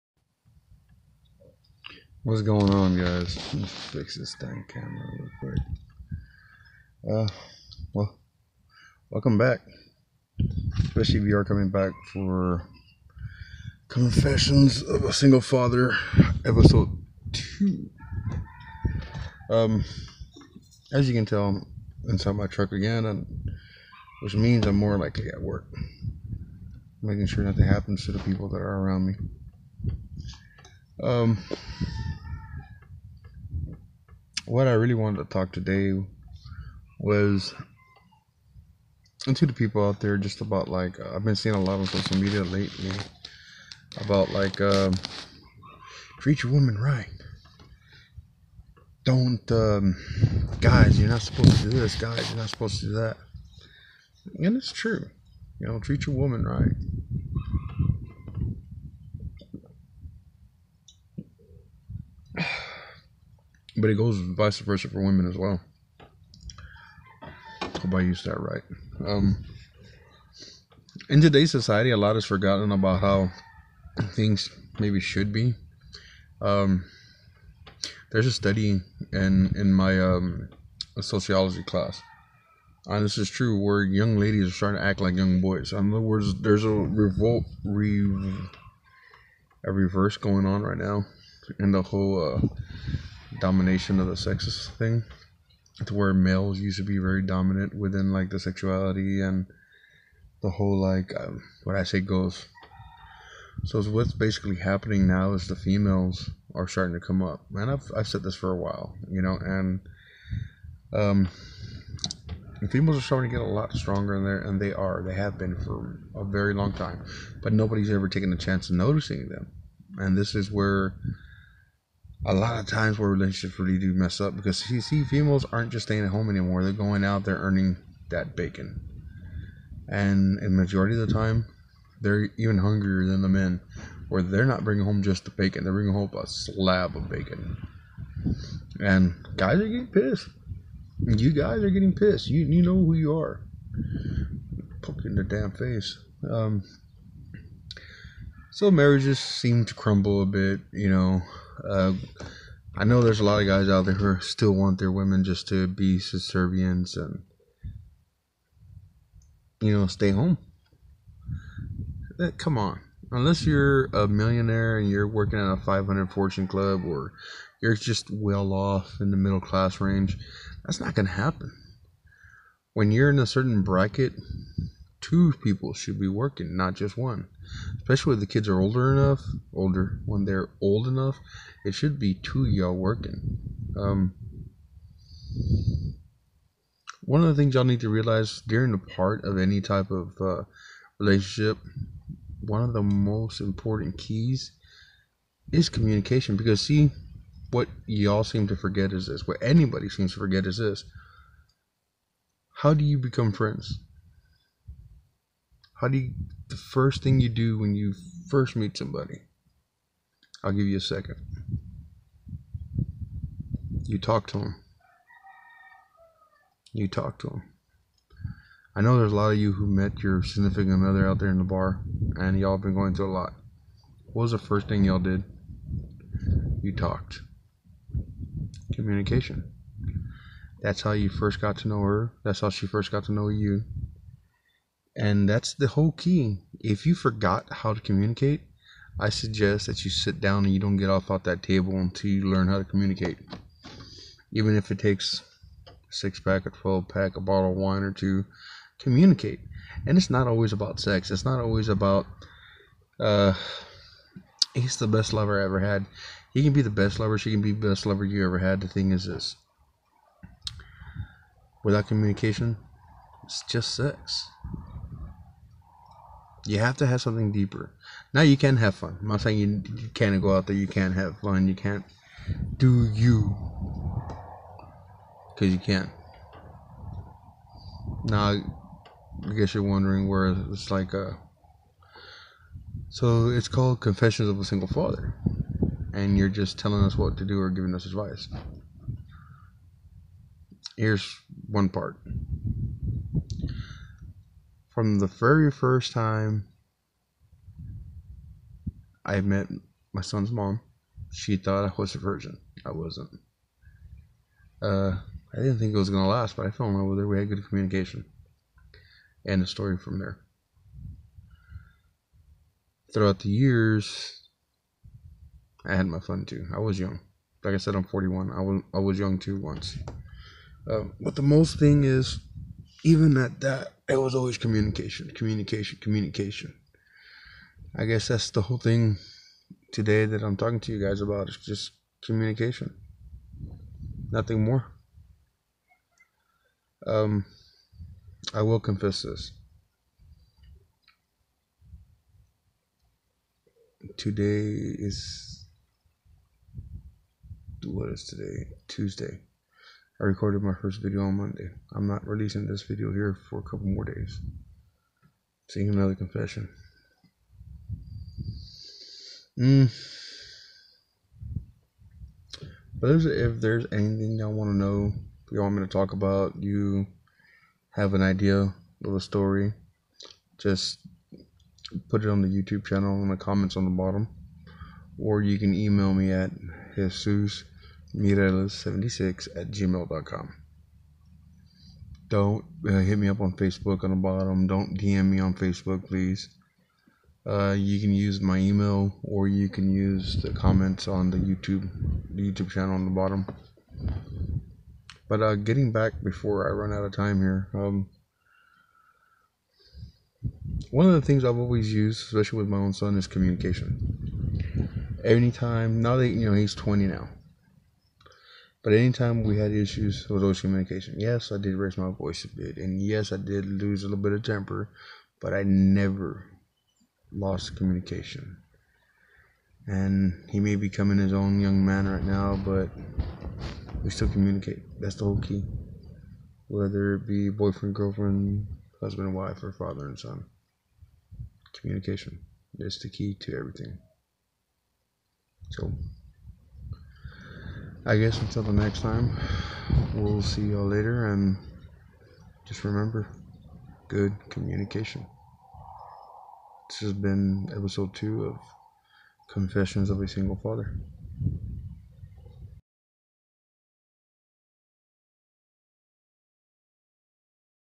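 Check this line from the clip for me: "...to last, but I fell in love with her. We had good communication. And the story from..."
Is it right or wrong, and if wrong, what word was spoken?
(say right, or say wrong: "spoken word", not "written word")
right.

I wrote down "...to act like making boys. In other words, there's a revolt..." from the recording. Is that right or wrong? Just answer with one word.
wrong.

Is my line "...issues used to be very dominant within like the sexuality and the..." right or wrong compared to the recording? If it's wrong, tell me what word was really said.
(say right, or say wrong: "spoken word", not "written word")
wrong: "males", not "issues".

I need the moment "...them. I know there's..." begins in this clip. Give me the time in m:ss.
3:37.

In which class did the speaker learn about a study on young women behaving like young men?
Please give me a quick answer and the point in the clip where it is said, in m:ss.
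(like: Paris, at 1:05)
Sociology, at 1:20.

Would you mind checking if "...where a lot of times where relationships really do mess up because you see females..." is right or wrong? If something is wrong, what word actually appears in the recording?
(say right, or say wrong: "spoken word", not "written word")
right.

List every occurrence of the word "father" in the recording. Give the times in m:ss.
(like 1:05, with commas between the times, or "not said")
0:15, 4:44, 7:09, 7:30.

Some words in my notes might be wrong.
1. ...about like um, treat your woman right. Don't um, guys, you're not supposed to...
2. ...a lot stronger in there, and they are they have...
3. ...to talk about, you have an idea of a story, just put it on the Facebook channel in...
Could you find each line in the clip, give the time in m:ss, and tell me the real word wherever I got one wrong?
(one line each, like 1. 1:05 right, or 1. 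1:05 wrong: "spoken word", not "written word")
1. 0:43 right
2. 1:53 right
3. 6:05 wrong: "YouTube", not "Facebook".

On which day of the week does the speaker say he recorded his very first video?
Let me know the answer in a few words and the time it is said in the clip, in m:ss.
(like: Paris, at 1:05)
Monday, at 5:51.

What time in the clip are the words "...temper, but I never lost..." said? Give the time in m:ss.
6:54.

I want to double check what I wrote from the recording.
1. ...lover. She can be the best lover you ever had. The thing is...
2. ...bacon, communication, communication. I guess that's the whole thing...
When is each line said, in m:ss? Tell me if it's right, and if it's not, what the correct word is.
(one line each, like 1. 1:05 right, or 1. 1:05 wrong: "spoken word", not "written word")
1. 4:16 right
2. 5:24 wrong: "communication", not "bacon".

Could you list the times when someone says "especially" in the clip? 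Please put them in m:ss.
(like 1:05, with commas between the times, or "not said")
0:10, 2:57, 6:42.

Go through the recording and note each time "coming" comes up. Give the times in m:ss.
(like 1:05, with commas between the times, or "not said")
0:11, 7:00.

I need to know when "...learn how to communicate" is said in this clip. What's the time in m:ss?
4:02.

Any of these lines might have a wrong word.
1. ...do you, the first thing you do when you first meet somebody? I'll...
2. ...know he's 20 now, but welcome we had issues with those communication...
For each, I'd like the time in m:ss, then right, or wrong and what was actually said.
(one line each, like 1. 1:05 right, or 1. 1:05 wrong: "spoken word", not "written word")
1. 3:25 right
2. 6:46 wrong: "anytime", not "welcome".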